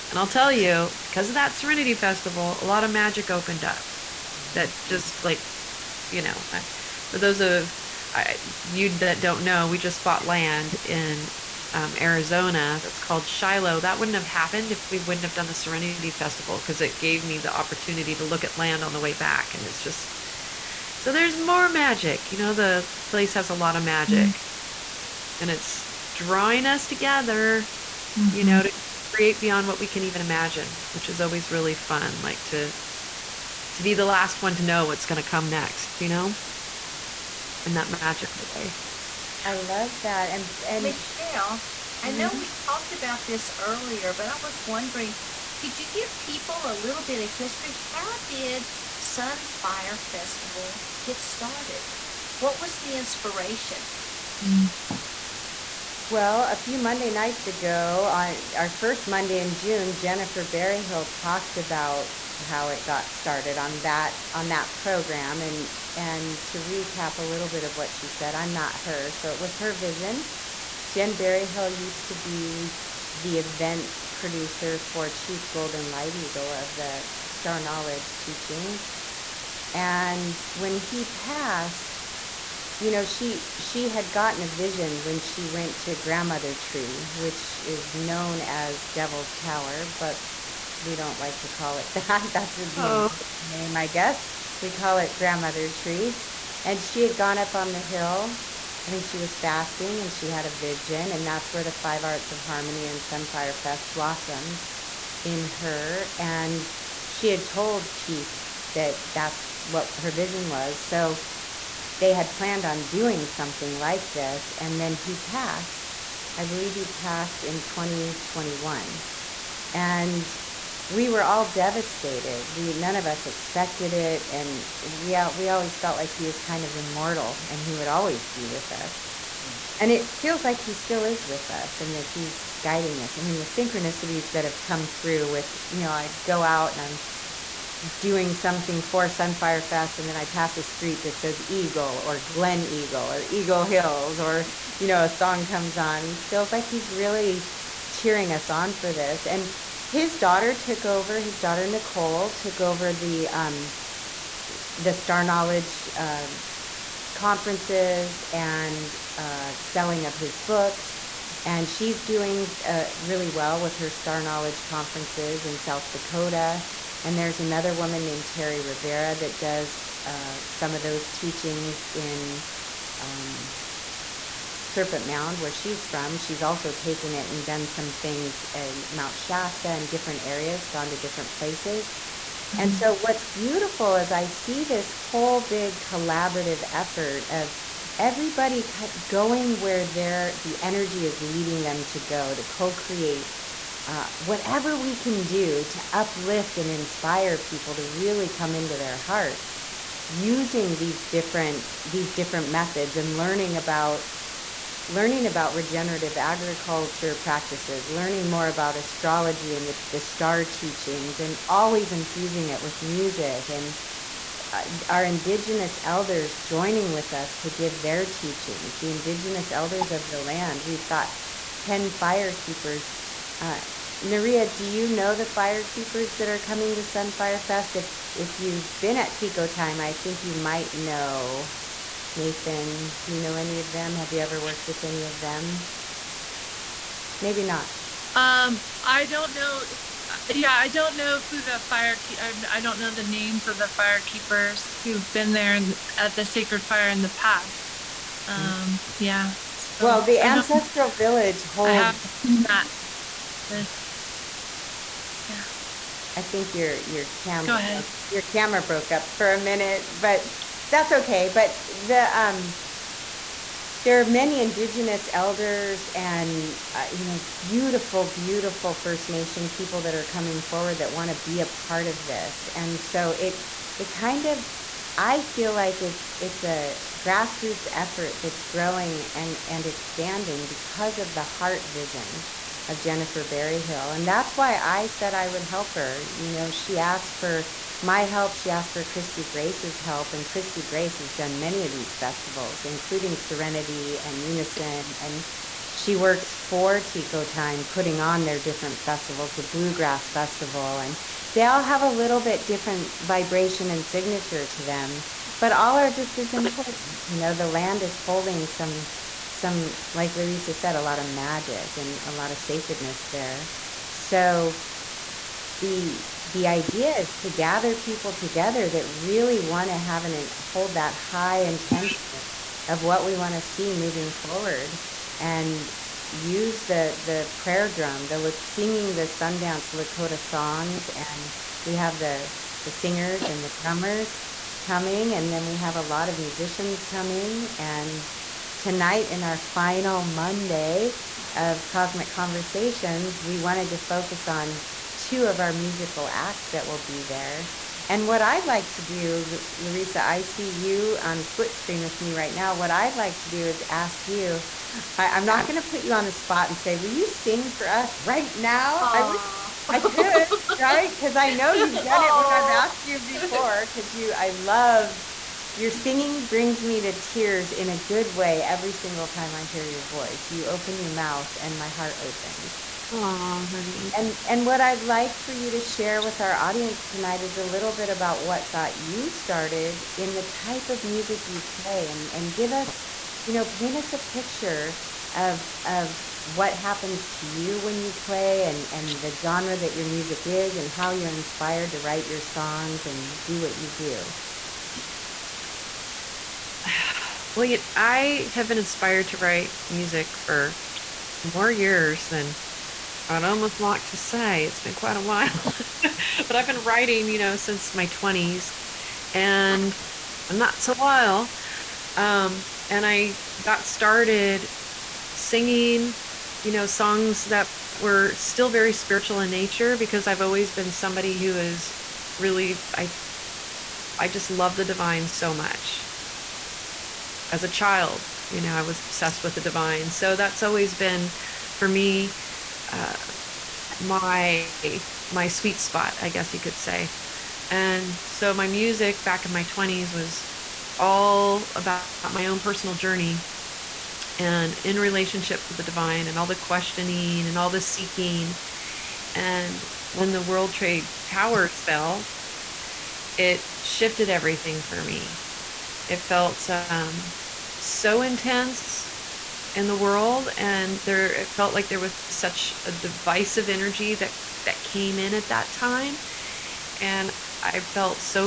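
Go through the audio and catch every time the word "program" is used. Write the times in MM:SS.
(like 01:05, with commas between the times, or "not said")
01:04.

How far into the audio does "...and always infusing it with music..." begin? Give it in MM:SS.
03:31.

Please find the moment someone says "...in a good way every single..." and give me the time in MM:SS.
06:07.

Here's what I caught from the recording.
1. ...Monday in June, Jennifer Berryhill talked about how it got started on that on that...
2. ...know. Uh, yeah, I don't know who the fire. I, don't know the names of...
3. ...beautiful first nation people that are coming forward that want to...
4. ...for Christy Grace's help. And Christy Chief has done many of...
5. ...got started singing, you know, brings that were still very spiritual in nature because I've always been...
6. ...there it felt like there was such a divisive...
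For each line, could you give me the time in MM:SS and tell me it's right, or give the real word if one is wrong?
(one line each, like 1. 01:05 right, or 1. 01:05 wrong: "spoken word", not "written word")
1. 00:59 right
2. 03:59 right
3. 04:28 right
4. 04:48 wrong: "Grace", not "Chief"
5. 06:53 wrong: "songs", not "brings"
6. 07:40 right.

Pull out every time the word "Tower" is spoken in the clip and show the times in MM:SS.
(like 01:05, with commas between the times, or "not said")
01:29, 07:31.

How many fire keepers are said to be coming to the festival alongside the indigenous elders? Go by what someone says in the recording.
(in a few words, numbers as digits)
10.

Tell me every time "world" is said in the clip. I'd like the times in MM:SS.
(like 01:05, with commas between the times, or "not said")
07:30, 07:39.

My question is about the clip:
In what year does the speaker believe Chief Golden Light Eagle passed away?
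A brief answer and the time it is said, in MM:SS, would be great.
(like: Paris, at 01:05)
2021, at 01:57.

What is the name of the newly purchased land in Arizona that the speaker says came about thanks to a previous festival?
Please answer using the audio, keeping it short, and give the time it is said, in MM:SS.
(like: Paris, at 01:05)
Shiloh, at 00:13.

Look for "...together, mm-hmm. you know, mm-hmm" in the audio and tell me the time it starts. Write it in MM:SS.
00:26.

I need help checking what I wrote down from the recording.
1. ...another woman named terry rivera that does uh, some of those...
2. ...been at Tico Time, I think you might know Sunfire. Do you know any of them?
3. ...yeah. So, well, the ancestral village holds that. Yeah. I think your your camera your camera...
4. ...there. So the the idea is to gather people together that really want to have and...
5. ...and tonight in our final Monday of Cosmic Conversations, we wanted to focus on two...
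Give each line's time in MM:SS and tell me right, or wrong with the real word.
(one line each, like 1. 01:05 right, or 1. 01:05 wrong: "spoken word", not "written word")
1. 02:47 right
2. 03:48 wrong: "Nathan", not "Sunfire"
3. 04:08 right
4. 05:13 right
5. 05:37 right.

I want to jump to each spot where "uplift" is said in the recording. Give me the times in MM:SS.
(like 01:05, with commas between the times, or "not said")
03:15.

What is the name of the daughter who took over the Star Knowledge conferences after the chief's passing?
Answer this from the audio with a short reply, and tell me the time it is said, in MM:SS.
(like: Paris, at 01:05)
Nicole, at 02:31.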